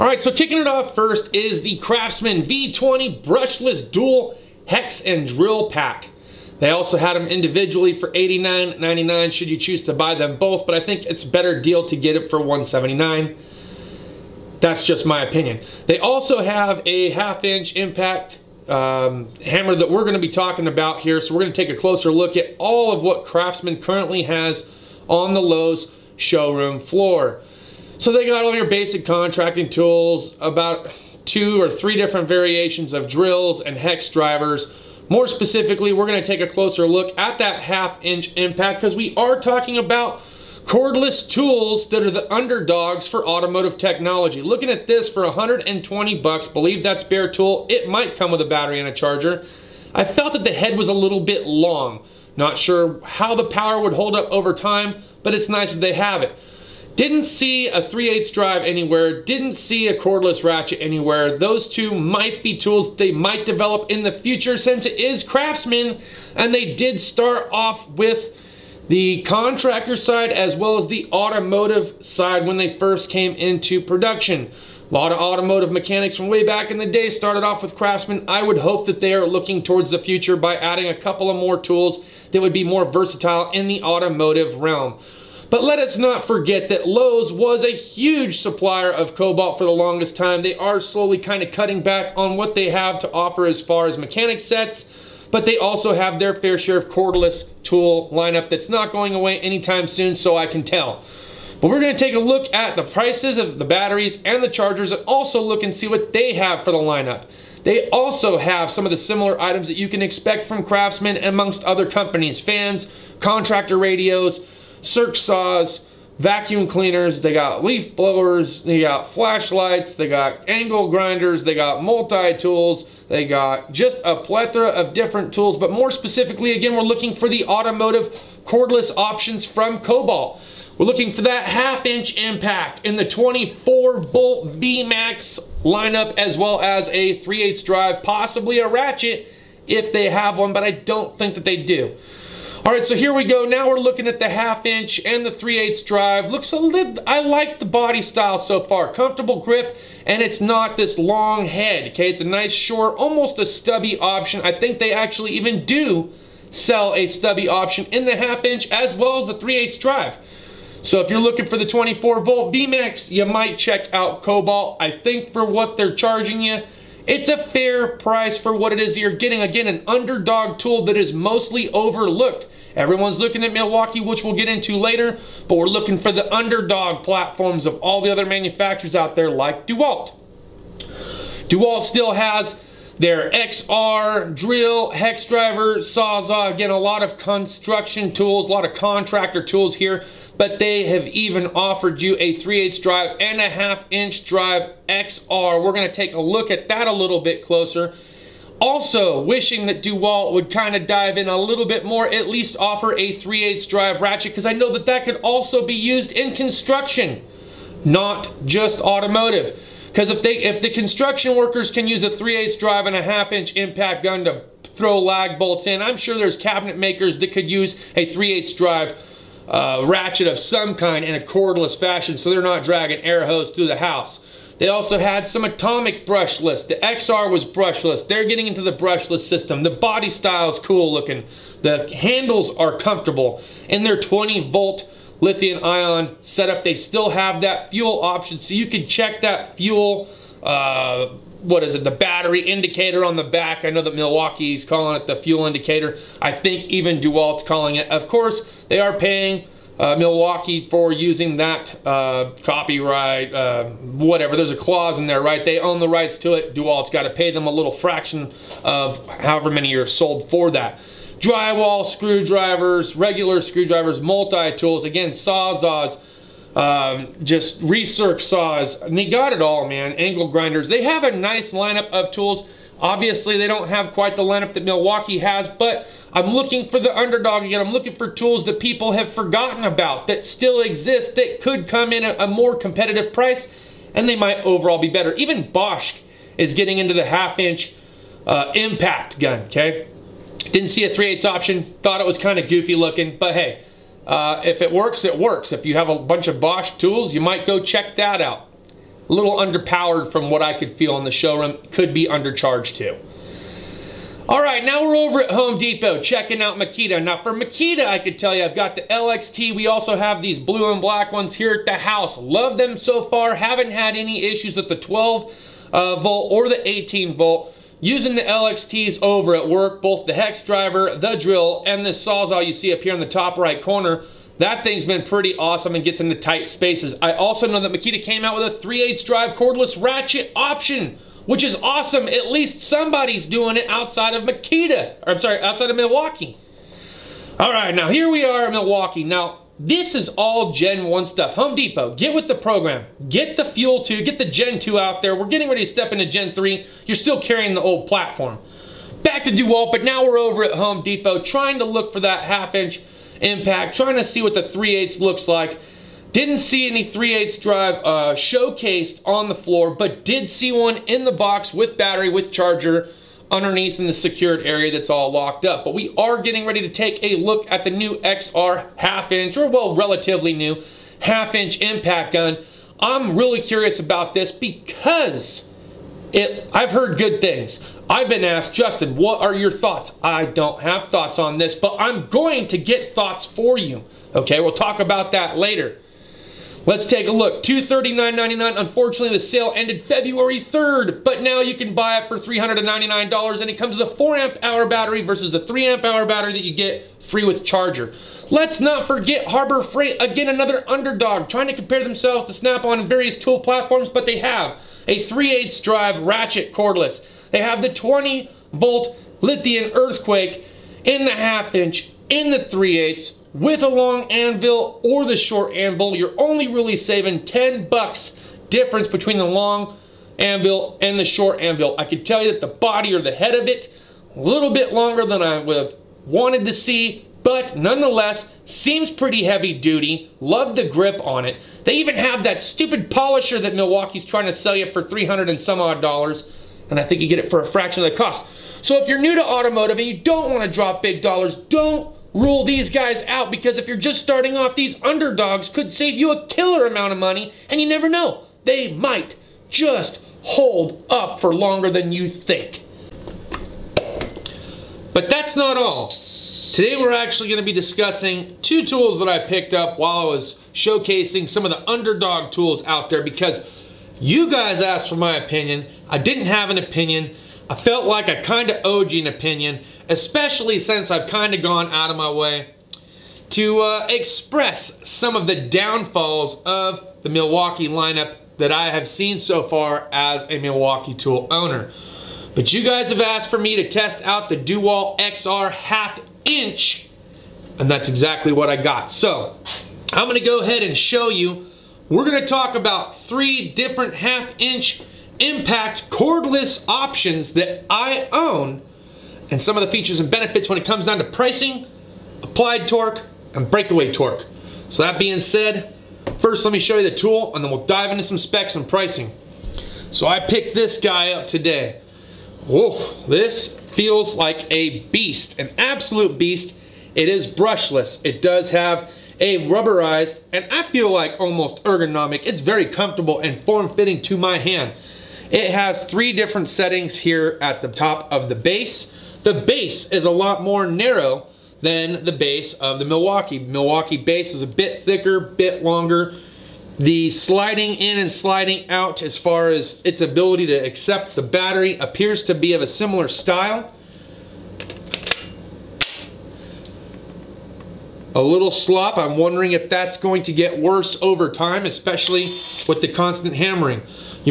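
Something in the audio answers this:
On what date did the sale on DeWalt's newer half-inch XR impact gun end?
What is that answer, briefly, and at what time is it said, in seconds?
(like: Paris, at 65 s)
February 3rd, at 389 s.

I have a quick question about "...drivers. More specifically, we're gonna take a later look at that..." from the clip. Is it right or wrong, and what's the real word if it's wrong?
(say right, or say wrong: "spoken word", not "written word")
wrong: "closer", not "later".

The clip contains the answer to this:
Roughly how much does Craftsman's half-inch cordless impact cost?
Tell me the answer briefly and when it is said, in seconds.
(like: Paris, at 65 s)
$120, at 45 s.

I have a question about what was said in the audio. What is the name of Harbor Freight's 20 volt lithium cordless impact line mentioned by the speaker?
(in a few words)
Earthquake.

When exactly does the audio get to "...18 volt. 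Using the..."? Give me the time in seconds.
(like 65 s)
316 s.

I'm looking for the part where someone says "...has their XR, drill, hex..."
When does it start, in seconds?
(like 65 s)
182 s.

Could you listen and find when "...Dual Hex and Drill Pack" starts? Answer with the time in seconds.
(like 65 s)
3 s.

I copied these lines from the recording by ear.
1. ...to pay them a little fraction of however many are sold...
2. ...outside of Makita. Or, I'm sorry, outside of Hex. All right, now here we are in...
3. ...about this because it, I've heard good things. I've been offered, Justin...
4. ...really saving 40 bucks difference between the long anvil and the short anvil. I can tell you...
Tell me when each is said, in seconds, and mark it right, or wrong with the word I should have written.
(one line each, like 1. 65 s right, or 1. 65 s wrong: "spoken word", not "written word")
1. 257 s right
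2. 333 s wrong: "Milwaukee", not "Hex"
3. 373 s wrong: "asked", not "offered"
4. 416 s wrong: "10", not "40".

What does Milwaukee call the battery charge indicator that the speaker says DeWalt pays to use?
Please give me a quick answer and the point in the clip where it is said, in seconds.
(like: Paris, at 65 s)
fuel indicator, at 245 s.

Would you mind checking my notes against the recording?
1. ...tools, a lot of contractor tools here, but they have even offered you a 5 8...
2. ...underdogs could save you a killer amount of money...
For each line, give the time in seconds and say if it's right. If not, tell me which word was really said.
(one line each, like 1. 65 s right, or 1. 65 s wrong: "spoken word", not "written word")
1. 188 s wrong: "3", not "5"
2. 444 s right.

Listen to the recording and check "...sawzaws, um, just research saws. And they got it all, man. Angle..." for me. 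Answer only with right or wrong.
right.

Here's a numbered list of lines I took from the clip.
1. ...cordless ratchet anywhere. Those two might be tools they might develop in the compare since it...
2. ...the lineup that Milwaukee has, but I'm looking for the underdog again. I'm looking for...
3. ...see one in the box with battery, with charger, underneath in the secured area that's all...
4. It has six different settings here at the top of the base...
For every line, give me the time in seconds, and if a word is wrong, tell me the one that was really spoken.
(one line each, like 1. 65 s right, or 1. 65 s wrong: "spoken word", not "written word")
1. 59 s wrong: "future", not "compare"
2. 274 s right
3. 360 s right
4. 525 s wrong: "three", not "six".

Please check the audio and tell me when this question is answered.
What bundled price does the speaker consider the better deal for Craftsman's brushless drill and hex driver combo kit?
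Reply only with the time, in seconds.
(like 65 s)
12 s.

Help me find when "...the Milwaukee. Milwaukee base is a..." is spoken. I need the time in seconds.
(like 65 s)
532 s.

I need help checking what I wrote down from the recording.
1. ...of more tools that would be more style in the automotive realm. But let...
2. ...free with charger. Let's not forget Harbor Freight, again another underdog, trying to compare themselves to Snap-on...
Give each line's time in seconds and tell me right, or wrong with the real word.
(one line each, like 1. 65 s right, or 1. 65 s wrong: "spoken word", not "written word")
1. 81 s wrong: "versatile", not "style"
2. 397 s right.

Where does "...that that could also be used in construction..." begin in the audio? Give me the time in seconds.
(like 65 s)
204 s.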